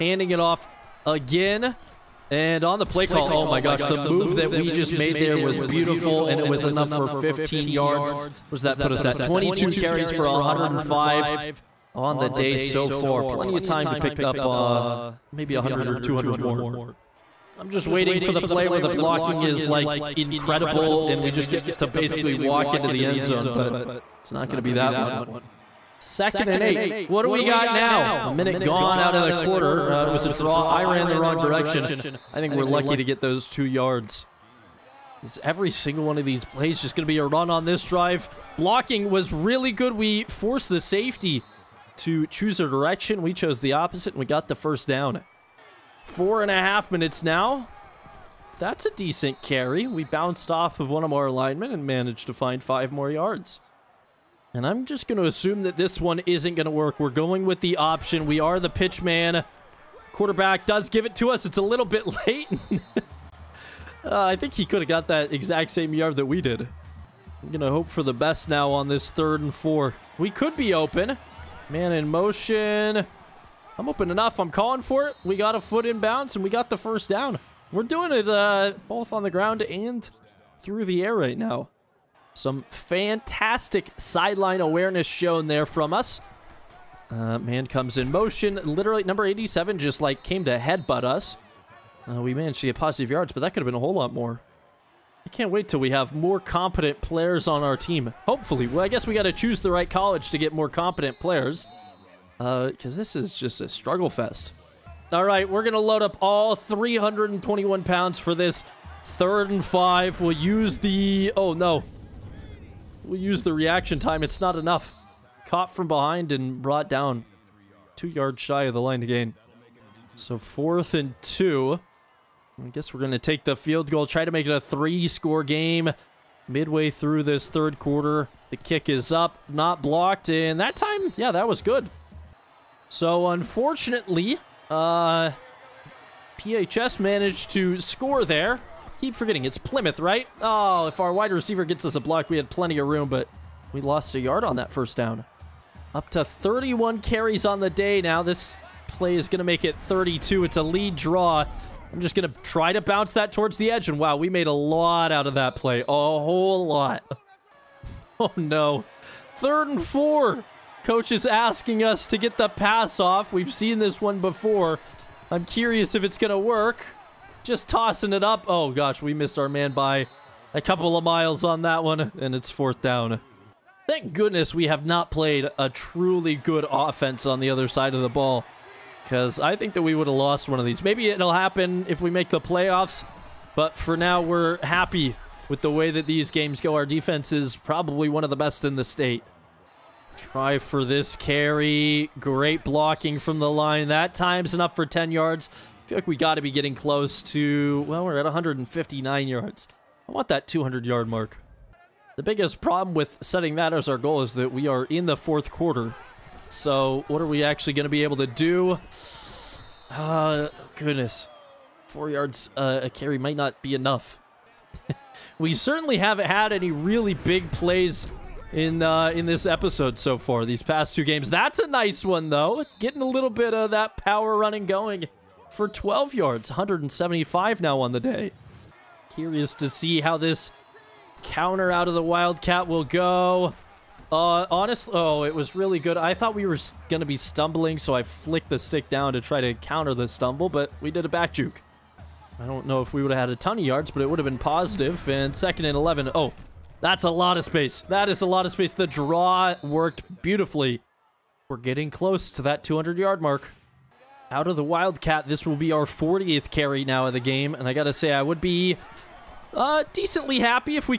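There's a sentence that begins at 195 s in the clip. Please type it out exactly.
I feel like we got to be getting close to, well, we're at 159 yards.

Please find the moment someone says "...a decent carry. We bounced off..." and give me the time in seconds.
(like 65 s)
48 s.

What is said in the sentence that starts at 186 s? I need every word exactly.
Our defense is probably one of the best in the state.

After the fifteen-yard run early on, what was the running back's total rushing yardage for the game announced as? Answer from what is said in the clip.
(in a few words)
105.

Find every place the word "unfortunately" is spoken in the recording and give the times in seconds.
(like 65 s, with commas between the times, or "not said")
133 s.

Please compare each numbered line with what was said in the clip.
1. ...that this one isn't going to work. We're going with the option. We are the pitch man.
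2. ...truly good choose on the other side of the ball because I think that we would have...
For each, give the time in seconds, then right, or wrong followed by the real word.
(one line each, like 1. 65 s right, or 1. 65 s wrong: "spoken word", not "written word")
1. 55 s right
2. 175 s wrong: "offense", not "choose".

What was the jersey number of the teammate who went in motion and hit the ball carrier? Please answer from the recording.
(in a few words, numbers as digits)
87.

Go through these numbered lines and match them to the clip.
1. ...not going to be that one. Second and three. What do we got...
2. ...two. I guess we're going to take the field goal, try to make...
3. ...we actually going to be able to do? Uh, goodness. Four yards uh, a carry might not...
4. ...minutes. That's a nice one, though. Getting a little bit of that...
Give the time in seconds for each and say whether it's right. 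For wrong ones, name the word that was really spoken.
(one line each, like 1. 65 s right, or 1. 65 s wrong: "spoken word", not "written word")
1. 24 s wrong: "eight", not "three"
2. 121 s right
3. 207 s right
4. 221 s wrong: "games", not "minutes".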